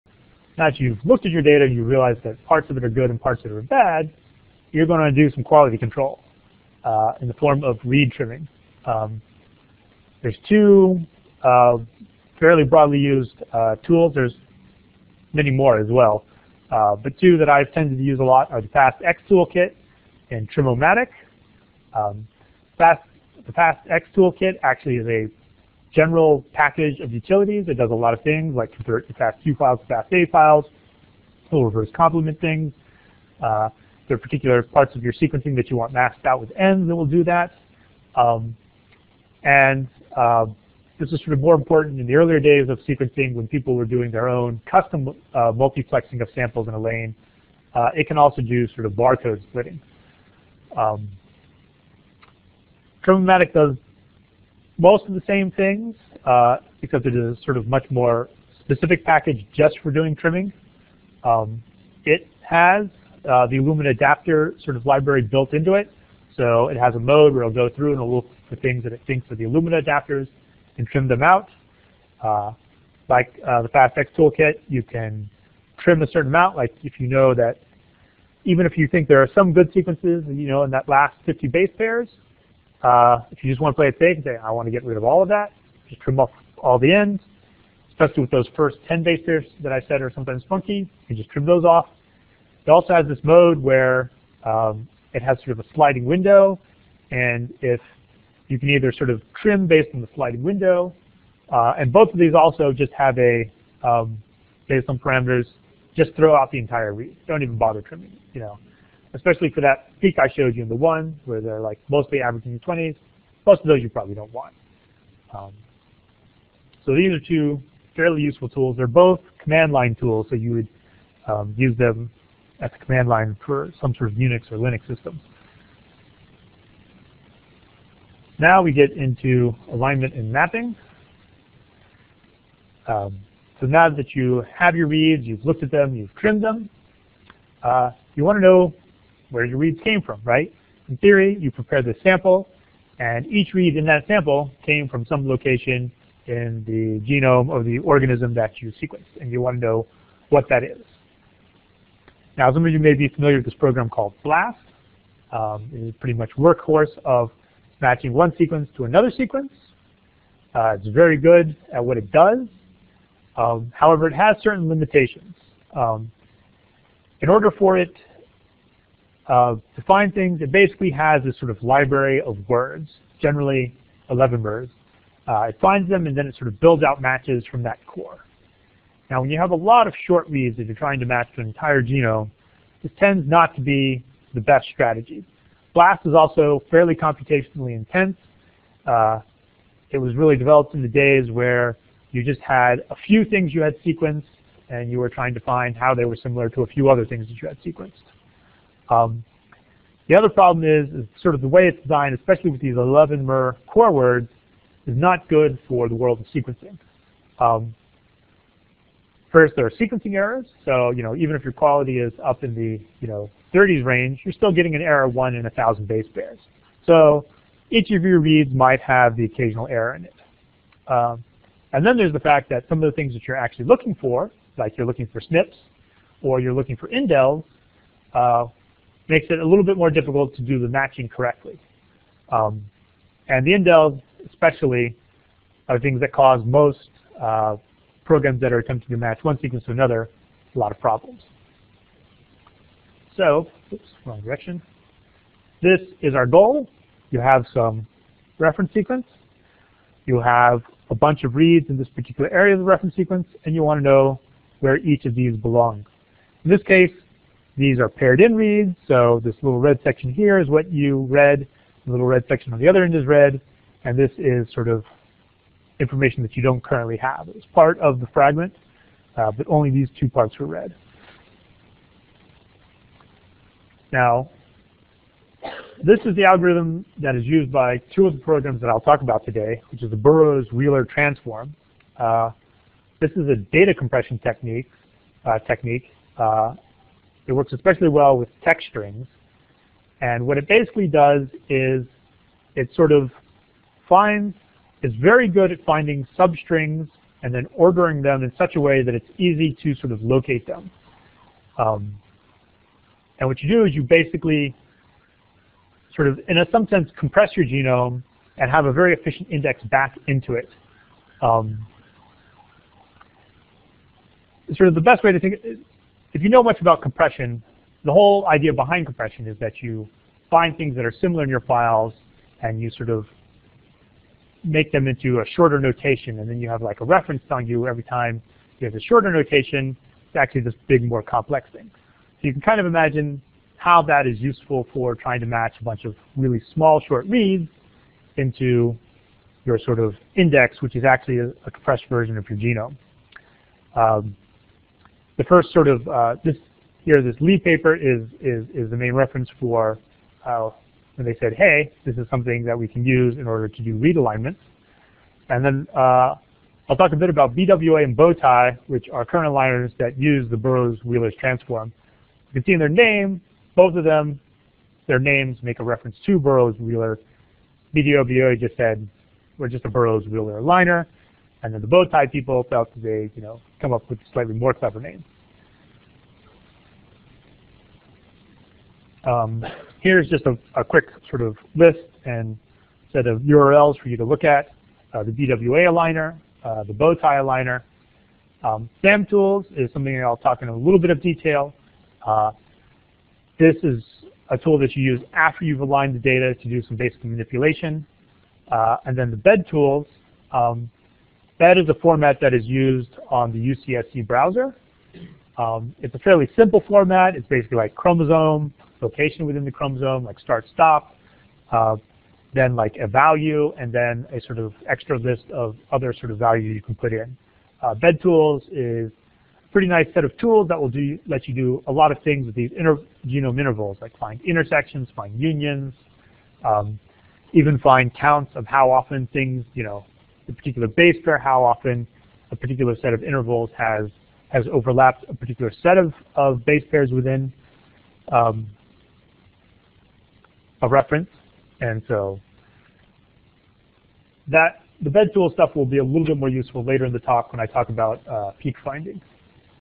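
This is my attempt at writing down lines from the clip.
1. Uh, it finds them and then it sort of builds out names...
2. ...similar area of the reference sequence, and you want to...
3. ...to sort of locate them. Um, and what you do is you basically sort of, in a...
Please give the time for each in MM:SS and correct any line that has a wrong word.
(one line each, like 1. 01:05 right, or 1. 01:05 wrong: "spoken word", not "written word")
1. 02:55 wrong: "matches", not "names"
2. 04:11 wrong: "particular", not "similar"
3. 04:59 right.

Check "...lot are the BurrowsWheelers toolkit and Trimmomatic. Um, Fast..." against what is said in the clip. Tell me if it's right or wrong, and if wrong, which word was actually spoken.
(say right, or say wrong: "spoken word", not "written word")
wrong: "FastX", not "BurrowsWheelers".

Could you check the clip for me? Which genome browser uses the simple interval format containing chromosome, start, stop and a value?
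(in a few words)
UCSC browser.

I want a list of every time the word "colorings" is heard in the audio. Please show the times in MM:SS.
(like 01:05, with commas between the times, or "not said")
not said.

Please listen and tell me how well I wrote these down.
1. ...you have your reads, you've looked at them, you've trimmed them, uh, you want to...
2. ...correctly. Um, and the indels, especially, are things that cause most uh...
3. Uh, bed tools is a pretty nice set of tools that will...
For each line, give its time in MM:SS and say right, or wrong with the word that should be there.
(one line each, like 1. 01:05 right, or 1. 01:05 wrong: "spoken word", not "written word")
1. 02:14 right
2. 03:51 right
3. 06:57 right.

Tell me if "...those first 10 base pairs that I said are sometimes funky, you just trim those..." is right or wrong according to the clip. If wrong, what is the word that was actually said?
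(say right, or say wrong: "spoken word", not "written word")
right.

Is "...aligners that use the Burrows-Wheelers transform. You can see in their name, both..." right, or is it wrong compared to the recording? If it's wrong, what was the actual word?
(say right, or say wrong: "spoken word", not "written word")
right.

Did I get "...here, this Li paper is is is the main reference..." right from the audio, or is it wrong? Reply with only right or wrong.
right.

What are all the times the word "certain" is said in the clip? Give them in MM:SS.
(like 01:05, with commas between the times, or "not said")
01:16, 02:44.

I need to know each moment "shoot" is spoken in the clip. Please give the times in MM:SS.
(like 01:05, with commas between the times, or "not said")
not said.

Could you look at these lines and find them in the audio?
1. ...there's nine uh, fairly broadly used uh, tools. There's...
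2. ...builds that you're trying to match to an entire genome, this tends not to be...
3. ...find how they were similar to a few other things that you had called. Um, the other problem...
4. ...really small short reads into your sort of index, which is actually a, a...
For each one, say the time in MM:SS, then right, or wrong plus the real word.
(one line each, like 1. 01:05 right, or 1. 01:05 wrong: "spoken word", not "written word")
1. 00:10 wrong: "two", not "nine"
2. 03:00 wrong: "reads", not "builds"
3. 03:15 wrong: "sequenced", not "called"
4. 05:36 right.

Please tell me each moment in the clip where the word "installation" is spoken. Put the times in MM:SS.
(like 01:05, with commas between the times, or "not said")
not said.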